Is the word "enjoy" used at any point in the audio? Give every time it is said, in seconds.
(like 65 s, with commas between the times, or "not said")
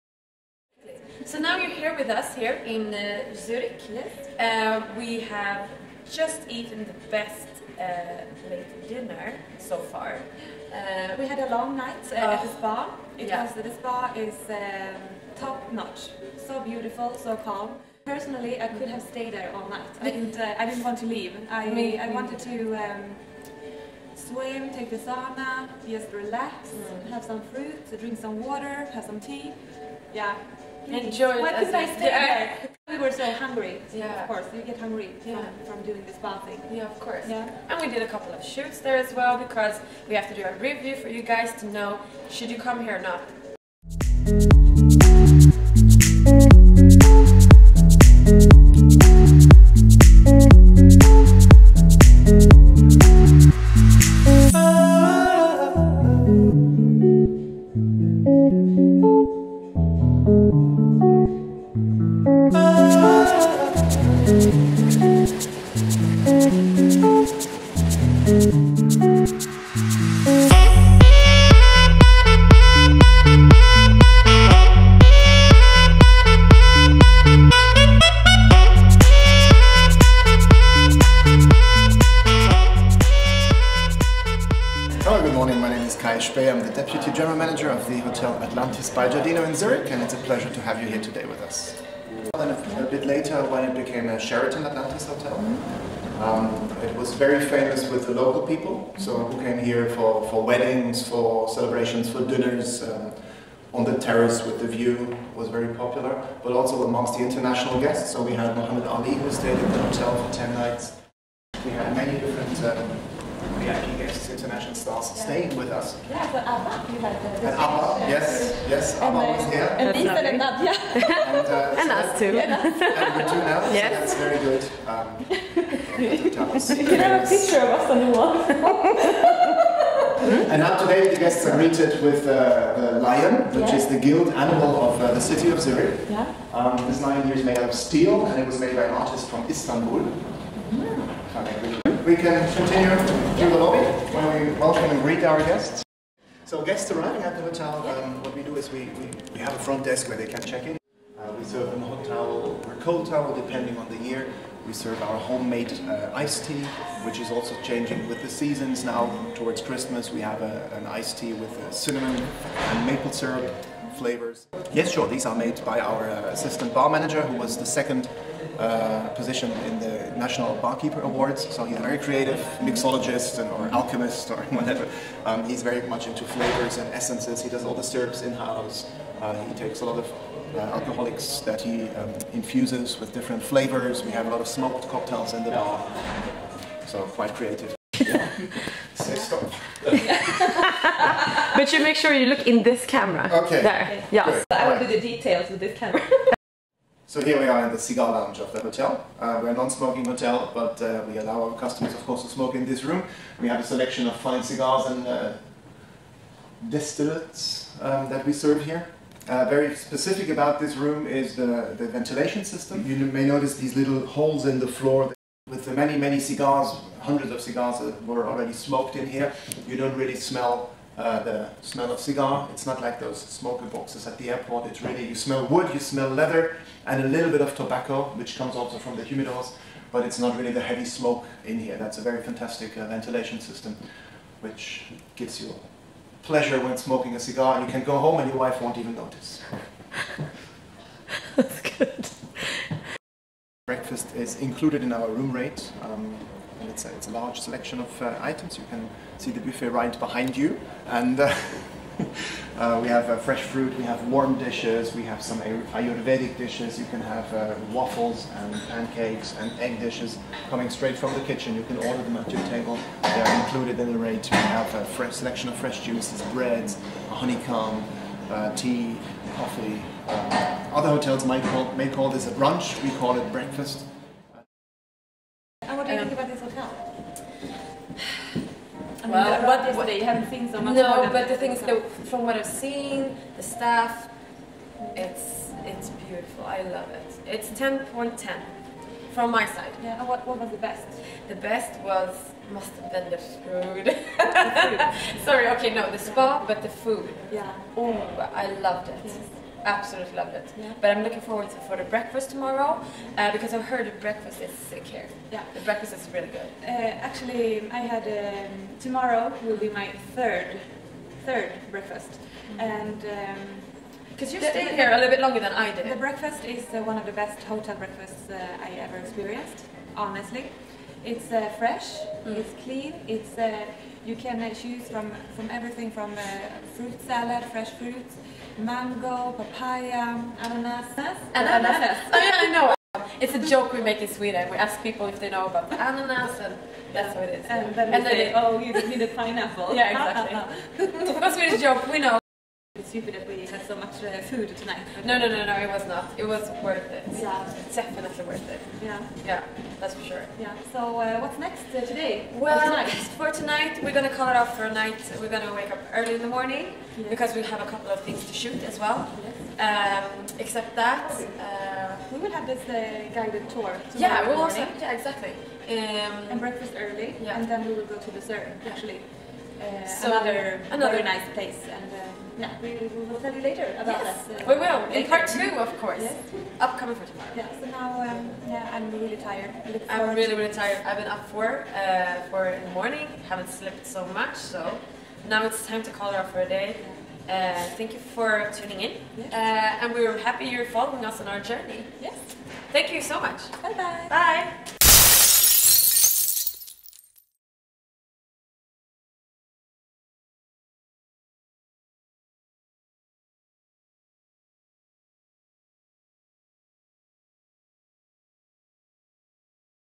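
30 s.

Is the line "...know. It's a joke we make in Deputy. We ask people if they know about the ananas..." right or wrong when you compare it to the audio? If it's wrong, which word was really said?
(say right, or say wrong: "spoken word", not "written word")
wrong: "Sweden", not "Deputy".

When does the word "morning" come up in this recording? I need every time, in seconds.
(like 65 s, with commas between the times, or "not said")
356 s, 382 s.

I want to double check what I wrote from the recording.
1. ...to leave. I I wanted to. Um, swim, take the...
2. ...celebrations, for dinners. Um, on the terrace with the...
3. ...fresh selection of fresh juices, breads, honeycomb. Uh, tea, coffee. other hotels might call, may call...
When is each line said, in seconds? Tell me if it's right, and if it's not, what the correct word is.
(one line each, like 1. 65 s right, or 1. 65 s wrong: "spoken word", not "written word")
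1. 20 s right
2. 101 s right
3. 264 s right.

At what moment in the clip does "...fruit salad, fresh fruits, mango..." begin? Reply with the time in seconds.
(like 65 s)
326 s.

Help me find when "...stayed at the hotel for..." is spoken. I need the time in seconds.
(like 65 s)
109 s.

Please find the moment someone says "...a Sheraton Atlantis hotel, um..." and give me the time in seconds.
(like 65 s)
94 s.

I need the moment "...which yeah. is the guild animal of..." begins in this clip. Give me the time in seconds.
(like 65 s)
133 s.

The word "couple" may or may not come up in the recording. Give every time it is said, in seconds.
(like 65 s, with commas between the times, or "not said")
38 s, 357 s.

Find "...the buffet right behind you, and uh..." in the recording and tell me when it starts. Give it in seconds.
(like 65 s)
249 s.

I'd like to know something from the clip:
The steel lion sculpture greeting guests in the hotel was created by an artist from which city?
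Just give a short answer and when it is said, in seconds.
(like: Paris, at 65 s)
Istanbul, at 139 s.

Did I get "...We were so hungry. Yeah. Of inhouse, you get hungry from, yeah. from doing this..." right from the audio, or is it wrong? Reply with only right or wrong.
wrong.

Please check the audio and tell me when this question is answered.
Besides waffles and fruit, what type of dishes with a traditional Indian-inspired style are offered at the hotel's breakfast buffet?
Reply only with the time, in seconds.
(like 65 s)
255 s.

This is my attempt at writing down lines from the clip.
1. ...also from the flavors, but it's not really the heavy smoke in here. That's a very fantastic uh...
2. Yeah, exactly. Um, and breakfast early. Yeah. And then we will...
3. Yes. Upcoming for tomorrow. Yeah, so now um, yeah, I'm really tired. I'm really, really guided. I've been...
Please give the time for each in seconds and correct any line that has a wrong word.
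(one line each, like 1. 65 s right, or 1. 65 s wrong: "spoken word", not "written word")
1. 228 s wrong: "humidors", not "flavors"
2. 364 s right
3. 376 s wrong: "tired", not "guided".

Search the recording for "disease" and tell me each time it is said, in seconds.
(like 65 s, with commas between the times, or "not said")
not said.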